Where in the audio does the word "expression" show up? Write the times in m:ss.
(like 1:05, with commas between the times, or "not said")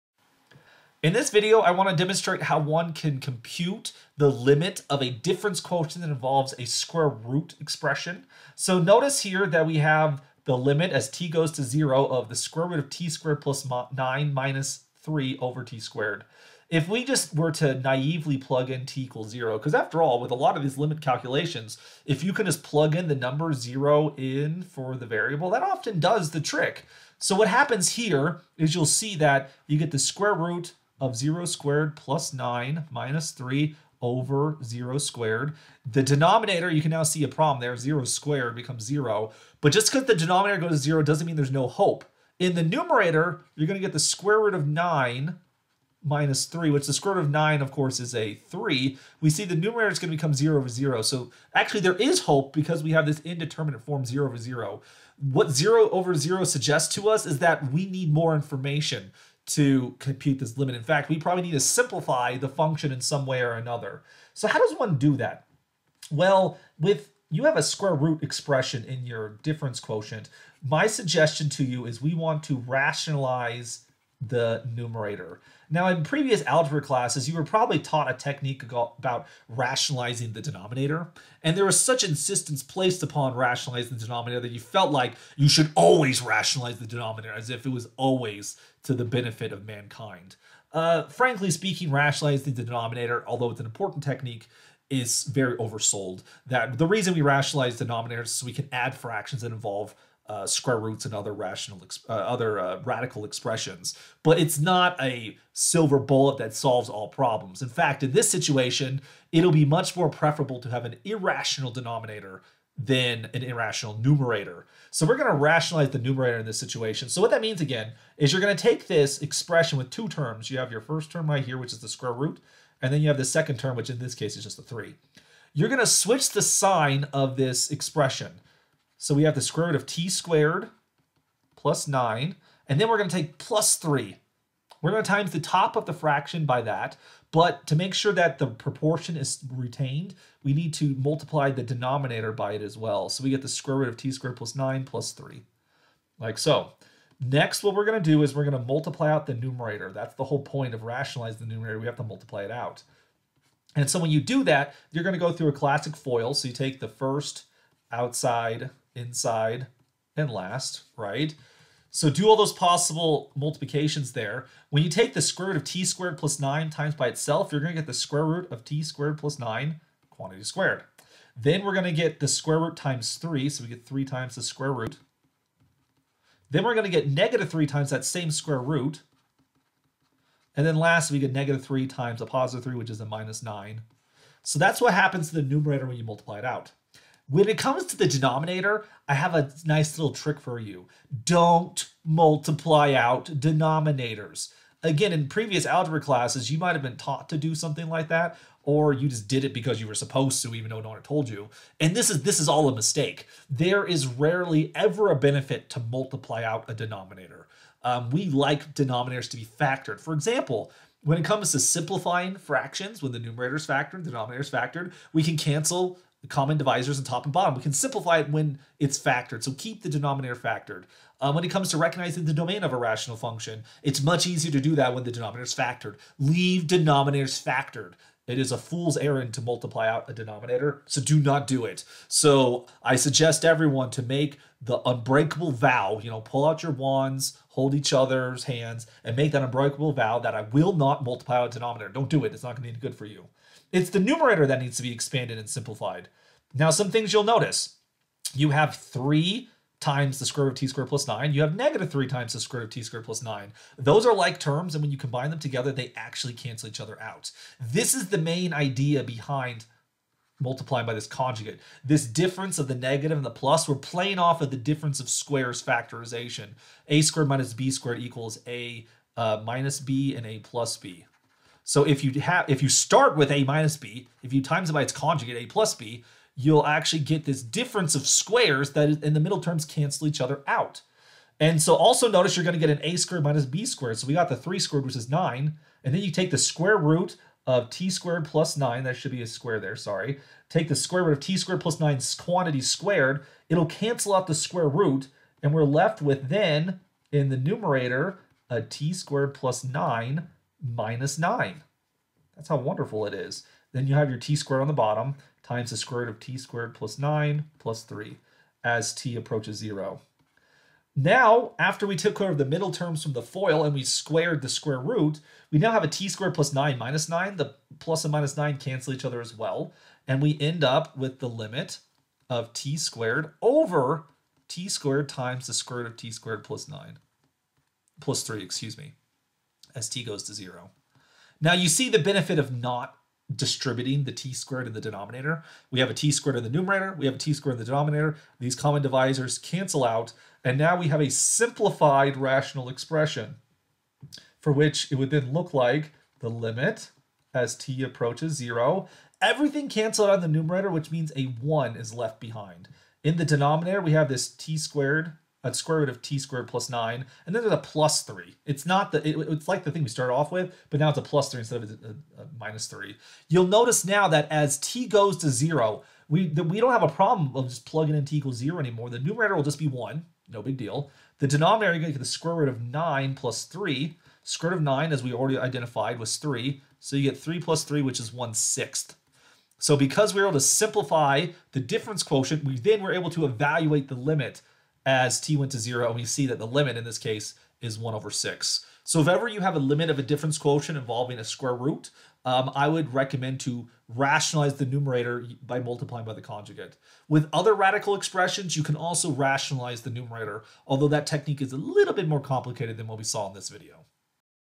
0:07, 1:08, 1:43, 1:59, 2:07, 5:42, 6:37.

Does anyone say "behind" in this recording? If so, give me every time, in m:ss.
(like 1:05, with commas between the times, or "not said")
4:19, 5:52.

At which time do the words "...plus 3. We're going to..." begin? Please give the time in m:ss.
2:13.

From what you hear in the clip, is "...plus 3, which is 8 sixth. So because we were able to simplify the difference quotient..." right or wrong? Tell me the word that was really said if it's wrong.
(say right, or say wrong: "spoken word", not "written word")
wrong: "1", not "8".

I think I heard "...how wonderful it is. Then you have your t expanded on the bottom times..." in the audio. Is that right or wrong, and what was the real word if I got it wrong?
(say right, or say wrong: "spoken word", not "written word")
wrong: "squared", not "expanded".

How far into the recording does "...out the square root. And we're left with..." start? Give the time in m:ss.
4:54.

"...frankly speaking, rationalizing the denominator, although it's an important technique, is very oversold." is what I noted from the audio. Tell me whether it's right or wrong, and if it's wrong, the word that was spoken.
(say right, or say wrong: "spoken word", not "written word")
right.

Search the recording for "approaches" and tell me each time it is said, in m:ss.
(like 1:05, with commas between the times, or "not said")
5:09, 5:47.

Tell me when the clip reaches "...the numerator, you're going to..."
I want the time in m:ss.
0:42.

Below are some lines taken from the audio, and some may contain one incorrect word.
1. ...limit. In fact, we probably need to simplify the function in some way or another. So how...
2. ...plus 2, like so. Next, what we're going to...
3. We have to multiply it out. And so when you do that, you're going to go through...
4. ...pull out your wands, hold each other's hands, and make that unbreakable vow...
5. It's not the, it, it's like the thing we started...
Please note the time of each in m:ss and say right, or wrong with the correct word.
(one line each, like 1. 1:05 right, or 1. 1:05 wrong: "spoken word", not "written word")
1. 1:00 right
2. 2:24 wrong: "3", not "2"
3. 2:31 right
4. 3:56 right
5. 5:58 right.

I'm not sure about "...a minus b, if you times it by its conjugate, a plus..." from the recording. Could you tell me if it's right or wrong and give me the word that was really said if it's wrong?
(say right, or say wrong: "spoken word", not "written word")
right.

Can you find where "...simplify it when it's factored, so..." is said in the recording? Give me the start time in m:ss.
3:37.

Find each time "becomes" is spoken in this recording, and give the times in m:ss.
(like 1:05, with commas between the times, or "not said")
0:38, 0:50.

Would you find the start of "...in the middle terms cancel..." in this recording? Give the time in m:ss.
4:39.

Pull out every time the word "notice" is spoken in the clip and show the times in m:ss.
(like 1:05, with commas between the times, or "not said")
0:08, 4:07, 4:42, 6:03.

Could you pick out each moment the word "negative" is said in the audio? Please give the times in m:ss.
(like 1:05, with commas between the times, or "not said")
2:57, 3:01, 4:11, 4:22.